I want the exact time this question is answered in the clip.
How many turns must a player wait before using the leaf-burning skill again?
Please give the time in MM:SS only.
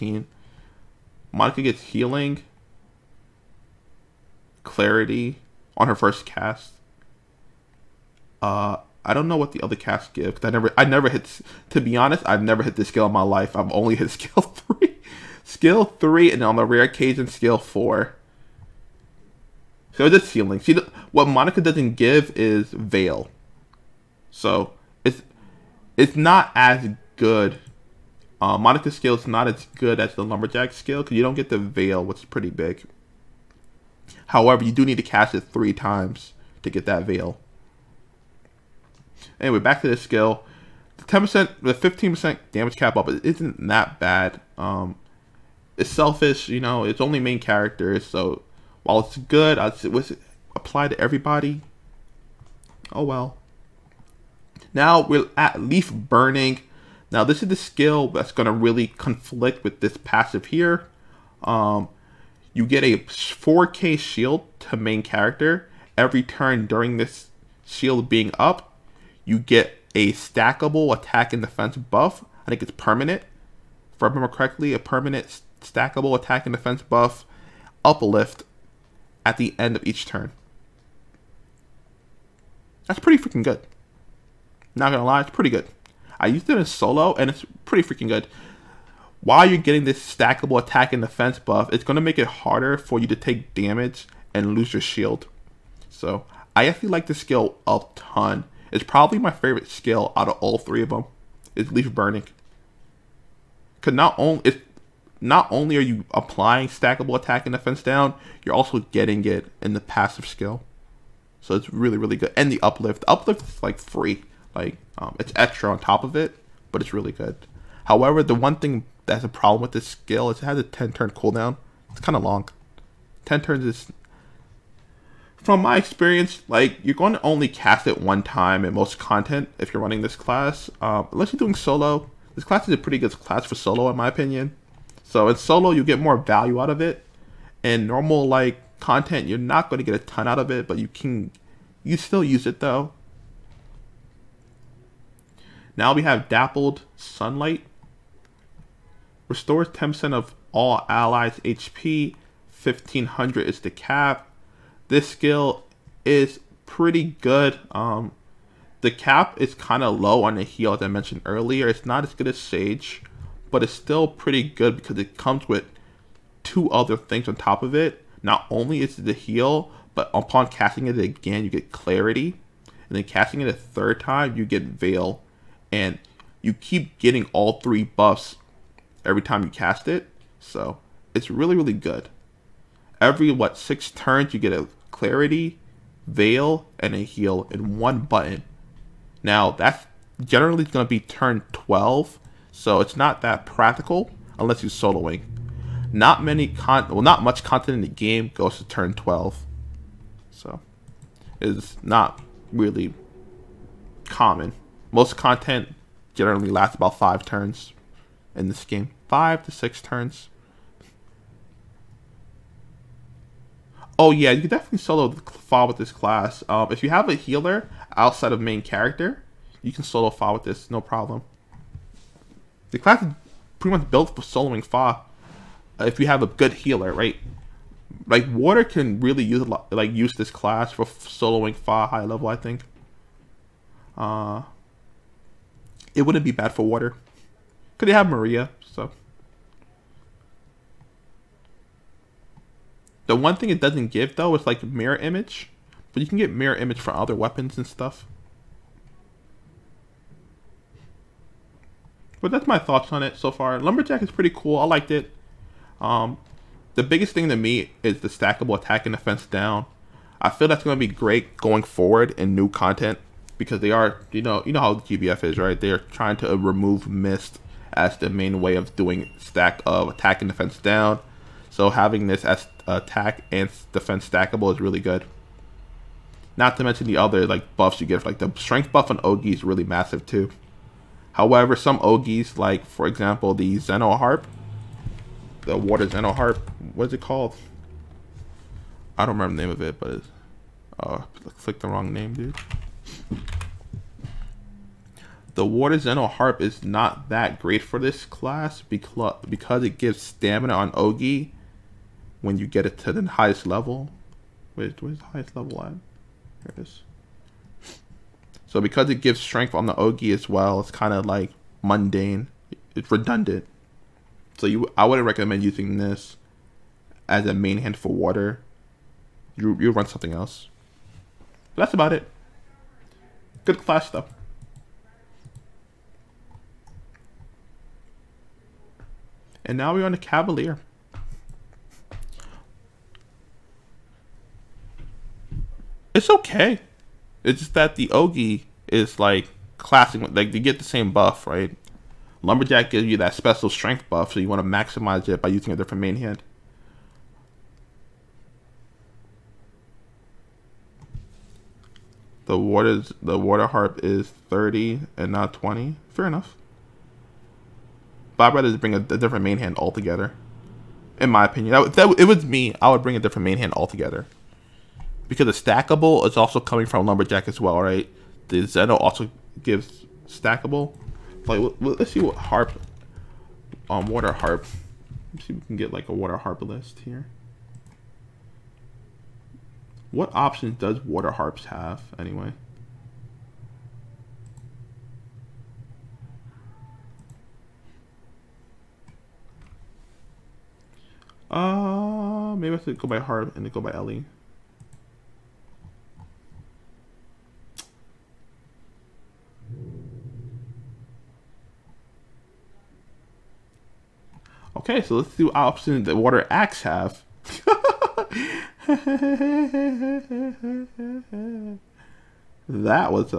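02:00.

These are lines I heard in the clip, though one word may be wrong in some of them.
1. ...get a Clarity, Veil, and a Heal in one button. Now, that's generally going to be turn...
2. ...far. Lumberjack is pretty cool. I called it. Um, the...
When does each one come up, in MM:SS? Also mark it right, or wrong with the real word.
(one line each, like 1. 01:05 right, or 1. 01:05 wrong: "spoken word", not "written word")
1. 03:04 right
2. 04:13 wrong: "liked", not "called".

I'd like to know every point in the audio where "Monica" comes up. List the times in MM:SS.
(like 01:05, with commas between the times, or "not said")
00:01, 00:21, 00:28.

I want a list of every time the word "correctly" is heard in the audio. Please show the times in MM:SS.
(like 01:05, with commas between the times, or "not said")
01:14.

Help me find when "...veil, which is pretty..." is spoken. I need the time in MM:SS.
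00:31.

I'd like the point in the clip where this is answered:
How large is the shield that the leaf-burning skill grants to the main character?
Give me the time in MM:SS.
01:02.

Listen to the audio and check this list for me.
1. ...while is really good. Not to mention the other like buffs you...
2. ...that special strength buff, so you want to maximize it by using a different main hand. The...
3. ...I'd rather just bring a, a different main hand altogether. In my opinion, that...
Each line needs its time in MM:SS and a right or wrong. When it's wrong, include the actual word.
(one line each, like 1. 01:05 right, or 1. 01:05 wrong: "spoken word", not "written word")
1. 04:34 wrong: "stackable", not "while"
2. 05:42 right
3. 05:58 right.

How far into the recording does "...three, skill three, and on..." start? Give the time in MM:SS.
00:14.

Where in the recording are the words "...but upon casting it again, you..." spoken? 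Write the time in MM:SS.
02:49.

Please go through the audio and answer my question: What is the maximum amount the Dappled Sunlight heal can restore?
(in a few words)
1500.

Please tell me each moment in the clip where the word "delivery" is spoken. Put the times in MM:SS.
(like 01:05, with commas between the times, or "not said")
not said.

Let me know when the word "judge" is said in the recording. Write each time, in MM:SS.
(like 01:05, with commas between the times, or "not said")
not said.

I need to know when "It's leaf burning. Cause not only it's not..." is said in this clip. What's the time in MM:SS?
01:41.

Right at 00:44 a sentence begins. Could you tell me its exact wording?
Um, it's selfish, you know, it's only main characters, so while it's good, I'd say, was it apply to everybody?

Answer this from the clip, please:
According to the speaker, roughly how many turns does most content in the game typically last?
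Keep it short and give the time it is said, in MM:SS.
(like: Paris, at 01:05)
five to six turns, at 03:29.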